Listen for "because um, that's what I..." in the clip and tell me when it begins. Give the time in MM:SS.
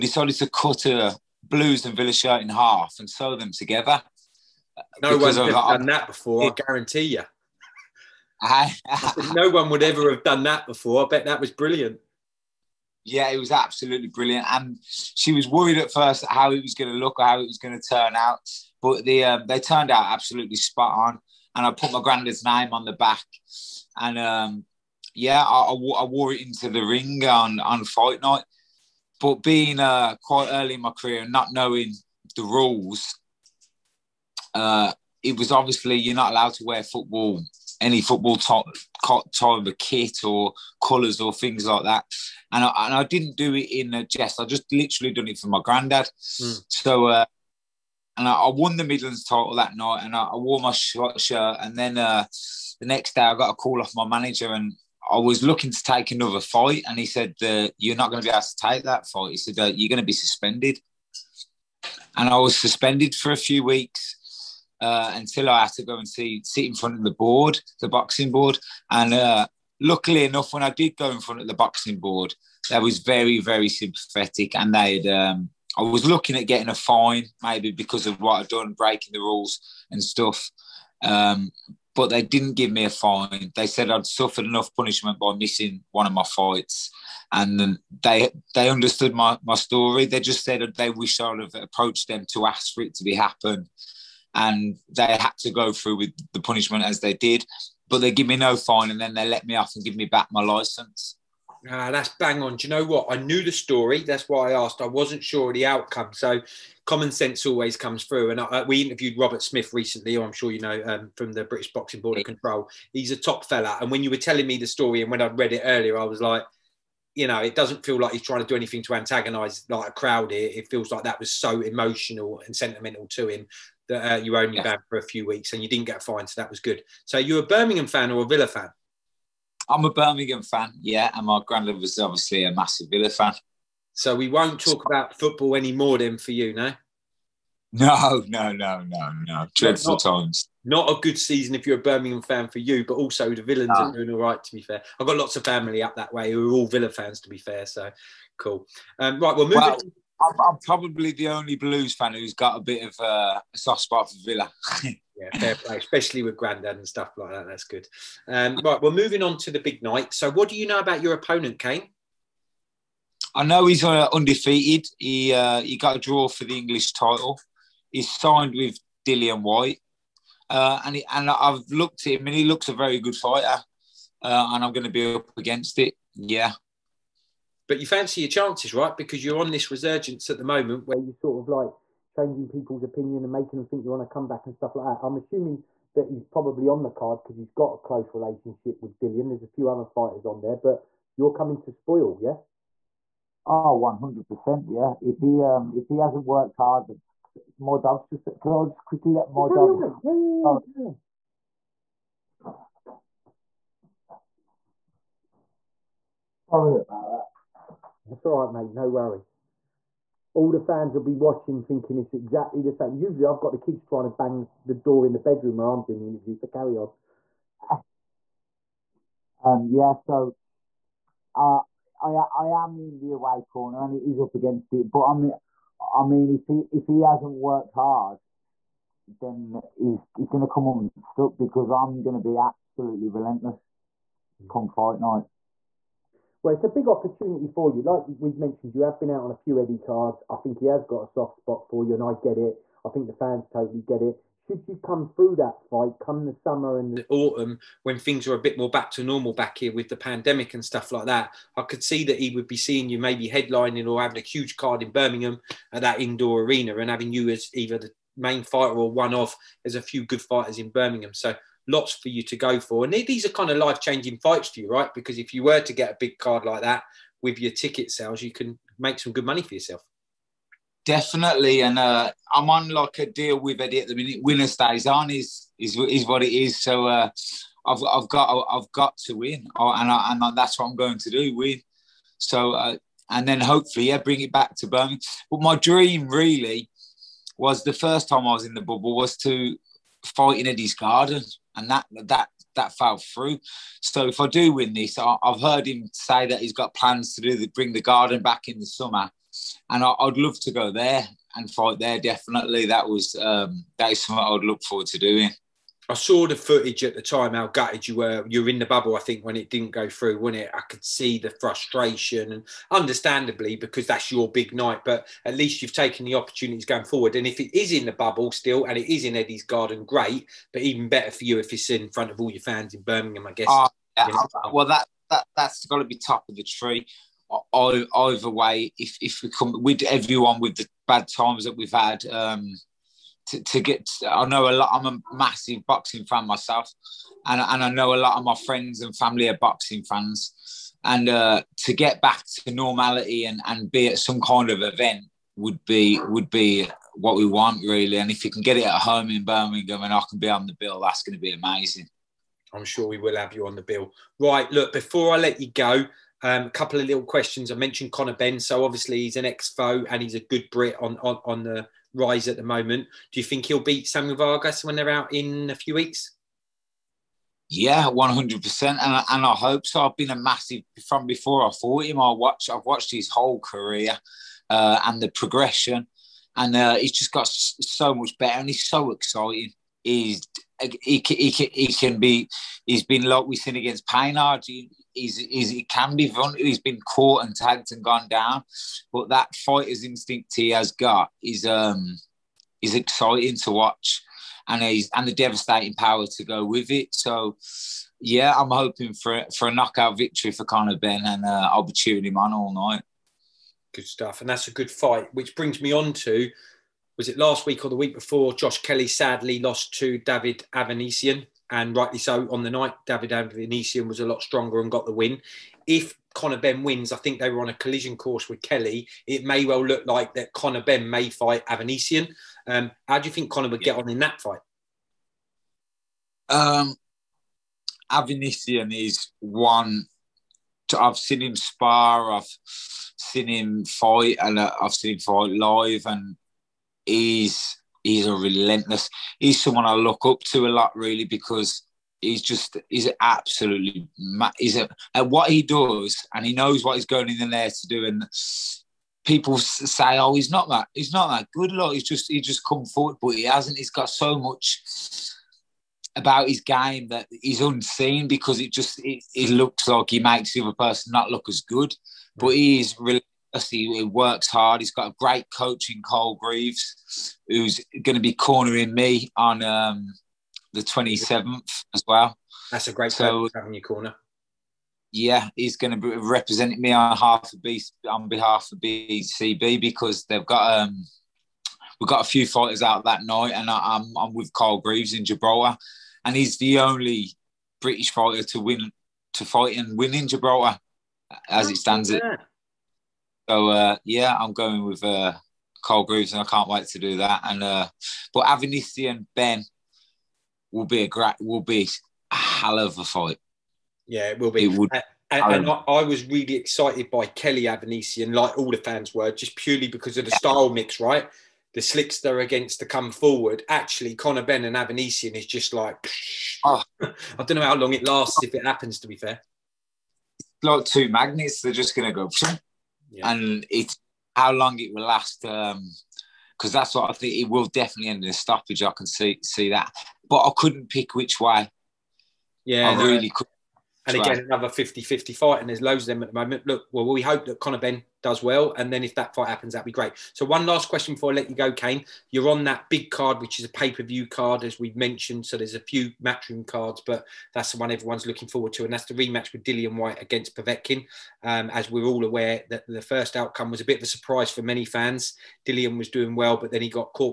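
08:45.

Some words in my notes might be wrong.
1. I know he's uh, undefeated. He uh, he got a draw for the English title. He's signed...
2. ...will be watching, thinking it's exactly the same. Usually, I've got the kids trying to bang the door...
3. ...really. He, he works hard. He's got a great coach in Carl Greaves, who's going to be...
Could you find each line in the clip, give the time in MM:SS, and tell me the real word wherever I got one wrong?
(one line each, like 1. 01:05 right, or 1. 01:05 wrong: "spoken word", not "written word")
1. 02:43 right
2. 03:30 right
3. 07:42 right.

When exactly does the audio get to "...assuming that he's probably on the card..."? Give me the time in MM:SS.
03:05.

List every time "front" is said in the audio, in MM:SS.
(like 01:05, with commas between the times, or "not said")
01:06, 01:11, 05:21.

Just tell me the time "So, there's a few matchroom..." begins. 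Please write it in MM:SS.
09:05.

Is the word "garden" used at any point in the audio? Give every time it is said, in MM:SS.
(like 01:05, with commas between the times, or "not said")
04:50, 04:57, 05:19.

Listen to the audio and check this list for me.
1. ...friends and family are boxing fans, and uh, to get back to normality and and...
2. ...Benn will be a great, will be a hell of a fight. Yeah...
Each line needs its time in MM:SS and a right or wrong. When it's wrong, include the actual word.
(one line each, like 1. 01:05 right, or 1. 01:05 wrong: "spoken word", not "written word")
1. 05:38 right
2. 08:19 right.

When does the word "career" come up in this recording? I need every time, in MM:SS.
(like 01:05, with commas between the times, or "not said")
00:30, 06:13.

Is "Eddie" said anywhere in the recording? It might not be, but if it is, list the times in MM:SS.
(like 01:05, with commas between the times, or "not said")
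03:59, 04:33, 04:50, 05:19.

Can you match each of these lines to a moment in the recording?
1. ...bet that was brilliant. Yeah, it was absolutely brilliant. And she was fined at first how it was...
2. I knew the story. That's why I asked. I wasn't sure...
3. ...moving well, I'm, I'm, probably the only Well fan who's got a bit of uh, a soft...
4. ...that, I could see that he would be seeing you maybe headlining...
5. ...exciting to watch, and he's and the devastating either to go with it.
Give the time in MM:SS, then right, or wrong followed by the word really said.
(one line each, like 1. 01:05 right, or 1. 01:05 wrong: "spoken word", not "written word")
1. 00:11 wrong: "worried", not "fined"
2. 01:43 right
3. 02:29 wrong: "Blues", not "Well"
4. 04:11 right
5. 06:32 wrong: "power", not "either".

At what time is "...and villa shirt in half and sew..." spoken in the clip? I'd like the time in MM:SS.
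00:01.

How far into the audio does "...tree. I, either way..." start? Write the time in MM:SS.
05:26.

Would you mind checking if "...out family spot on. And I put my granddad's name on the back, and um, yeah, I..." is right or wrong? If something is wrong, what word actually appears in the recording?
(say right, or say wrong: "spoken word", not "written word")
wrong: "absolutely", not "family".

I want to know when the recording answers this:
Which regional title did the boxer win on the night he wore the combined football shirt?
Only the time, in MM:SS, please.
00:48.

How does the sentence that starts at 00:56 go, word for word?
And he said, uh, You're not going to be able to take that fight.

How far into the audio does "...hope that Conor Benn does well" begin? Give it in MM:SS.
08:57.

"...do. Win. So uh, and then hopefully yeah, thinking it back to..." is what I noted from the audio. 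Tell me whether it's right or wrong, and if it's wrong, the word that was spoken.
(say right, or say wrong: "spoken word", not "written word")
wrong: "bring", not "thinking".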